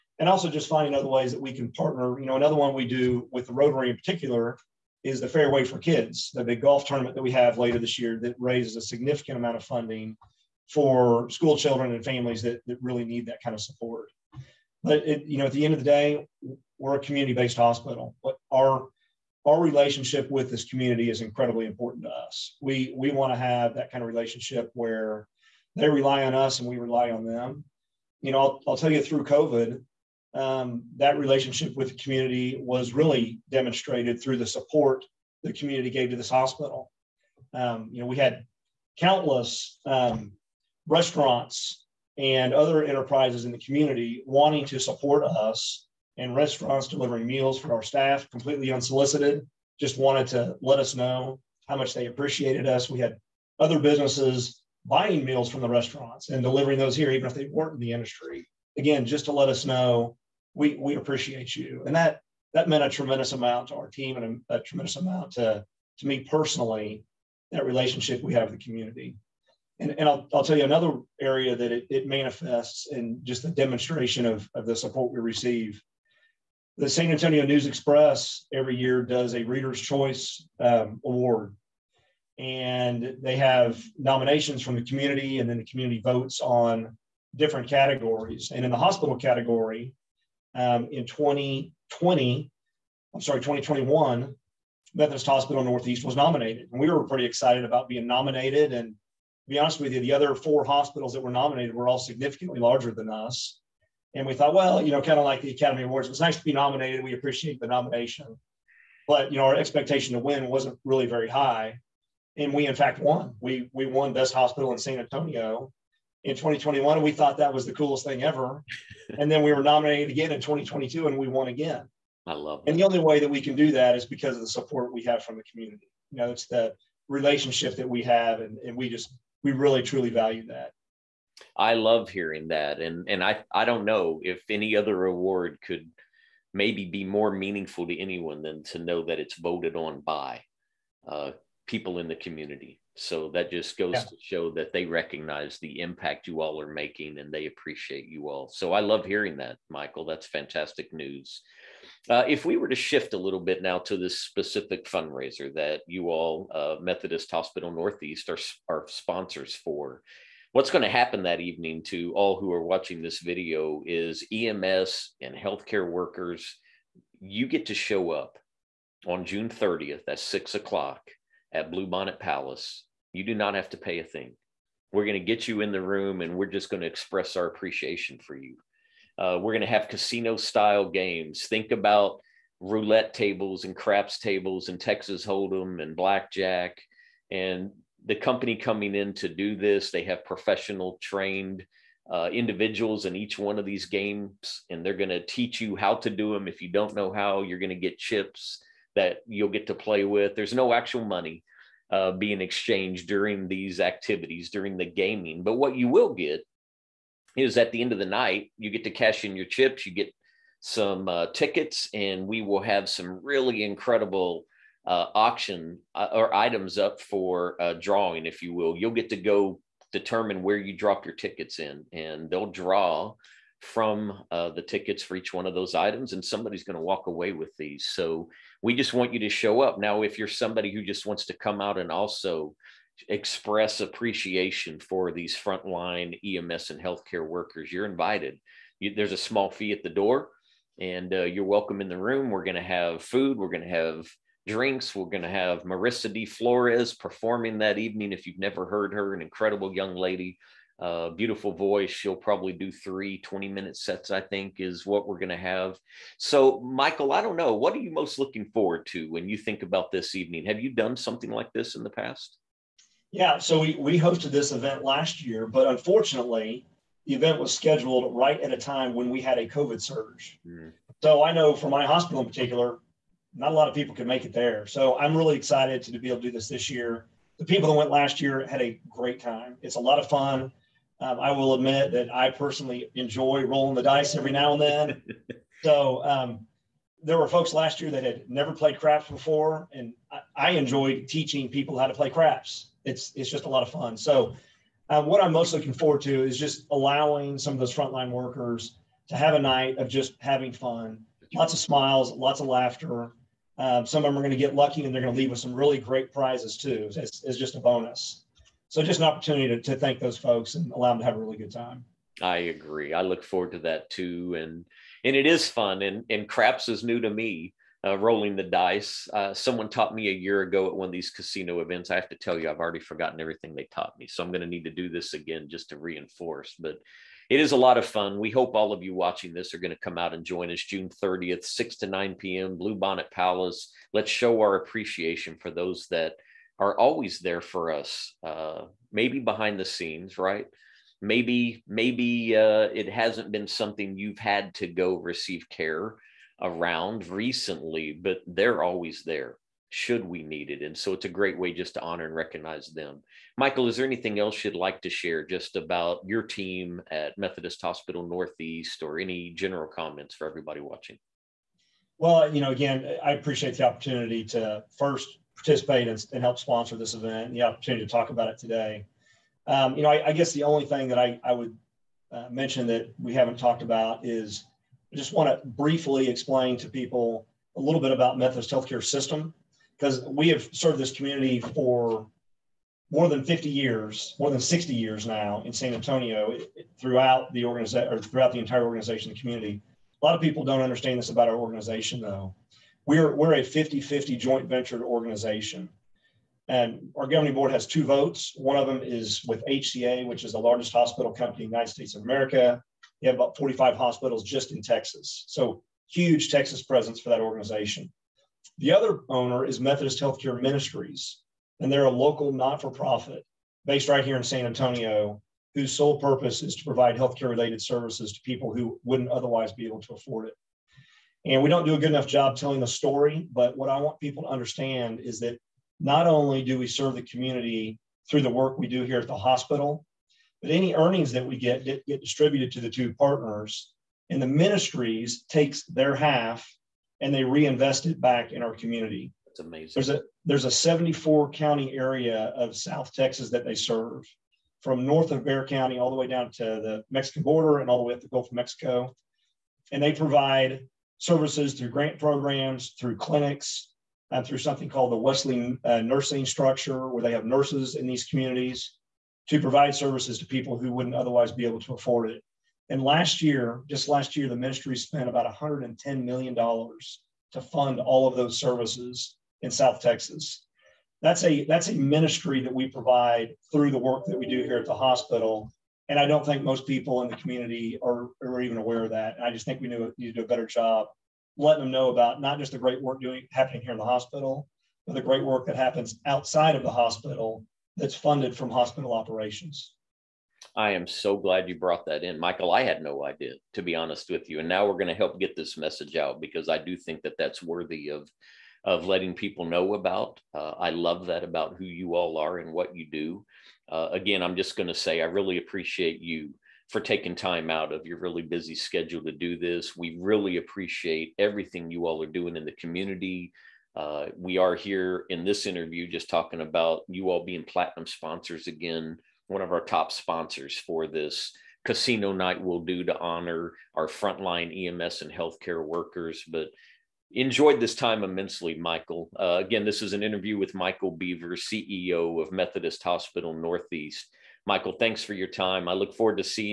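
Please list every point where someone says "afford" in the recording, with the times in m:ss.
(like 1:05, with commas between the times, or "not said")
6:59, 7:41.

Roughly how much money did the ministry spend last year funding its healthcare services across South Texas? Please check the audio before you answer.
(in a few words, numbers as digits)
$110 million.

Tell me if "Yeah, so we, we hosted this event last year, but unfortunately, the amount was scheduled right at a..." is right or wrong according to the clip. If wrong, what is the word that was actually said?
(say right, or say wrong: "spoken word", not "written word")
wrong: "event", not "amount".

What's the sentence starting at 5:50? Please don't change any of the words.
And so it's a great way just to honor and recognize them.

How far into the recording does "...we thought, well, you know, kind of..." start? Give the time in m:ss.
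1:44.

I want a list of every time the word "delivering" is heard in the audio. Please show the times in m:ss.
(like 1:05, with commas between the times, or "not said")
0:46, 0:56.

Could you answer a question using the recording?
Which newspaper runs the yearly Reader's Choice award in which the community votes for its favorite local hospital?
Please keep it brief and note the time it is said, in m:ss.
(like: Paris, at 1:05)
San Antonio News Express, at 1:16.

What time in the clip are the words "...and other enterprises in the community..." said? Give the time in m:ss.
0:42.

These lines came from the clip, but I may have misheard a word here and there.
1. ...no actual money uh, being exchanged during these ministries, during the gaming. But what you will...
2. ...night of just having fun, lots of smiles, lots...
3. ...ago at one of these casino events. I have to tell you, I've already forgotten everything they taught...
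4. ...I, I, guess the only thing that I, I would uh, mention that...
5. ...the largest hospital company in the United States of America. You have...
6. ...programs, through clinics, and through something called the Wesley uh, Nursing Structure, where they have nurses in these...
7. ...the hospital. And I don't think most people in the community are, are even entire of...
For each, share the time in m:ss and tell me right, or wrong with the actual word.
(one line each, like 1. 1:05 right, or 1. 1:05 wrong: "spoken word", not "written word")
1. 3:20 wrong: "activities", not "ministries"
2. 4:59 right
3. 5:20 right
4. 6:09 right
5. 6:40 right
6. 7:31 right
7. 7:54 wrong: "aware", not "entire".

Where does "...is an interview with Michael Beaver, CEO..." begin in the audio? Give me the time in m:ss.
8:49.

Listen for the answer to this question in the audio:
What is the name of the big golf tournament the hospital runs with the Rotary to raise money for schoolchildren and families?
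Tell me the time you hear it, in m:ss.
0:05.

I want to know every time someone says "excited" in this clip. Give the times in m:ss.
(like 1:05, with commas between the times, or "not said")
1:37, 4:35.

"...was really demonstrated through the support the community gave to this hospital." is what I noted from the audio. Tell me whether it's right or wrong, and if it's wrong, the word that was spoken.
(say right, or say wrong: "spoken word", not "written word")
right.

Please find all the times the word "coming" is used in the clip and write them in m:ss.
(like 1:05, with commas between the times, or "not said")
3:08.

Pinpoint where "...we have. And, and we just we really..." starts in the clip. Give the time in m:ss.
2:07.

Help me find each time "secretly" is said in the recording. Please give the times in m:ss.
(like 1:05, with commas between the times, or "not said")
not said.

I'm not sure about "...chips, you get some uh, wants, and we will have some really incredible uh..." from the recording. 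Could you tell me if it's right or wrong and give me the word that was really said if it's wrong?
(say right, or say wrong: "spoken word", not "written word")
wrong: "tickets", not "wants".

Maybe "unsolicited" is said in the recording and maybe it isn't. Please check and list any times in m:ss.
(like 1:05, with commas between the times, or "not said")
0:48.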